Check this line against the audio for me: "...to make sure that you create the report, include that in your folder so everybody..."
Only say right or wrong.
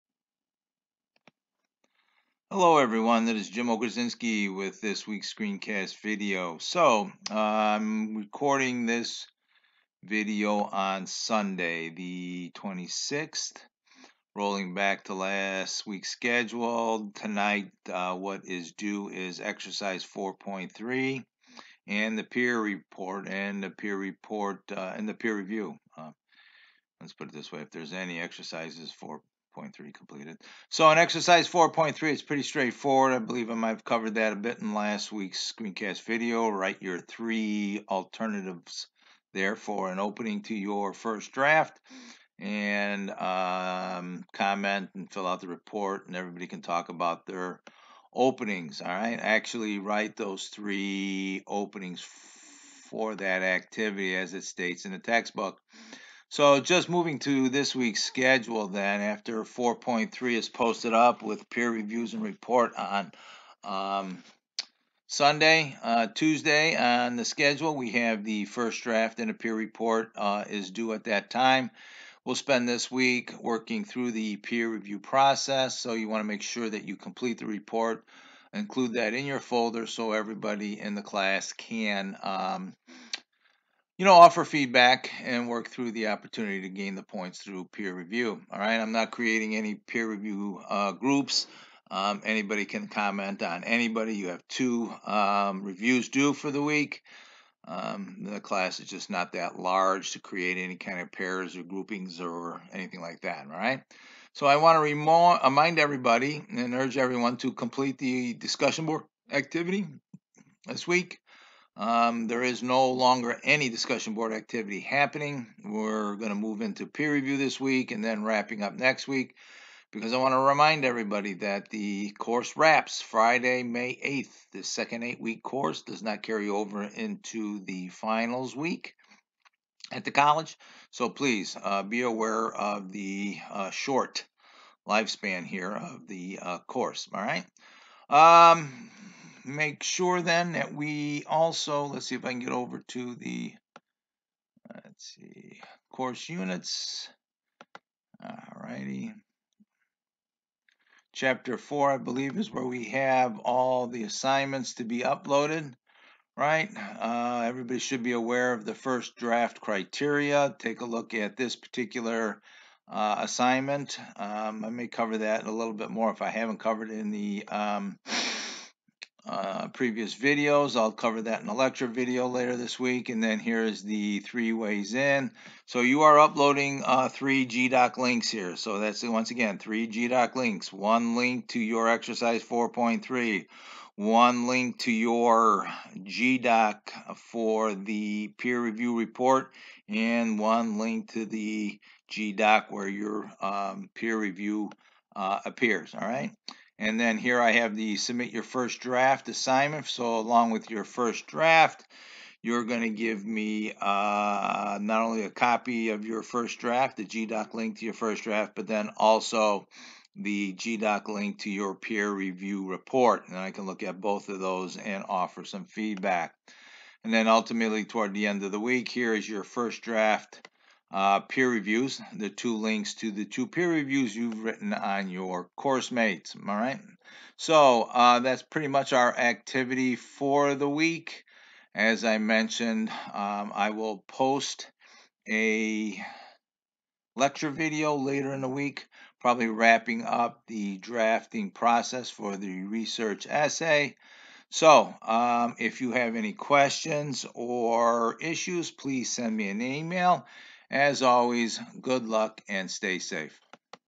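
wrong.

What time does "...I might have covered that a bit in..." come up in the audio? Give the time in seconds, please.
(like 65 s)
33 s.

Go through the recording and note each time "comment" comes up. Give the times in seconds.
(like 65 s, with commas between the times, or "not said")
44 s, 92 s.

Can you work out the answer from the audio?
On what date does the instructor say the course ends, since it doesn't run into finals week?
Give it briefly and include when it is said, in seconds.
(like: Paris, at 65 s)
Friday, May 8th, at 123 s.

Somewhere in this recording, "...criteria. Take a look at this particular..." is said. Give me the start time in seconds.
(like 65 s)
159 s.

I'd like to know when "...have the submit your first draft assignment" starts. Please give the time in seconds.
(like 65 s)
197 s.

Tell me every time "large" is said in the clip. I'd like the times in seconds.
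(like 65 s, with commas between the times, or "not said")
99 s.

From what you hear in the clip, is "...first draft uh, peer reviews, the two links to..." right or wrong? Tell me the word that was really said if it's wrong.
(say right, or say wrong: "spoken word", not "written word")
right.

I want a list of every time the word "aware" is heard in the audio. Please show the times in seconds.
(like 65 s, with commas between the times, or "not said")
132 s, 158 s.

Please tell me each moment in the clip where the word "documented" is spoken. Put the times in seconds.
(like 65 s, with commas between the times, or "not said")
not said.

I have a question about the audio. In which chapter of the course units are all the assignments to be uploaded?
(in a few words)
Chapter 4.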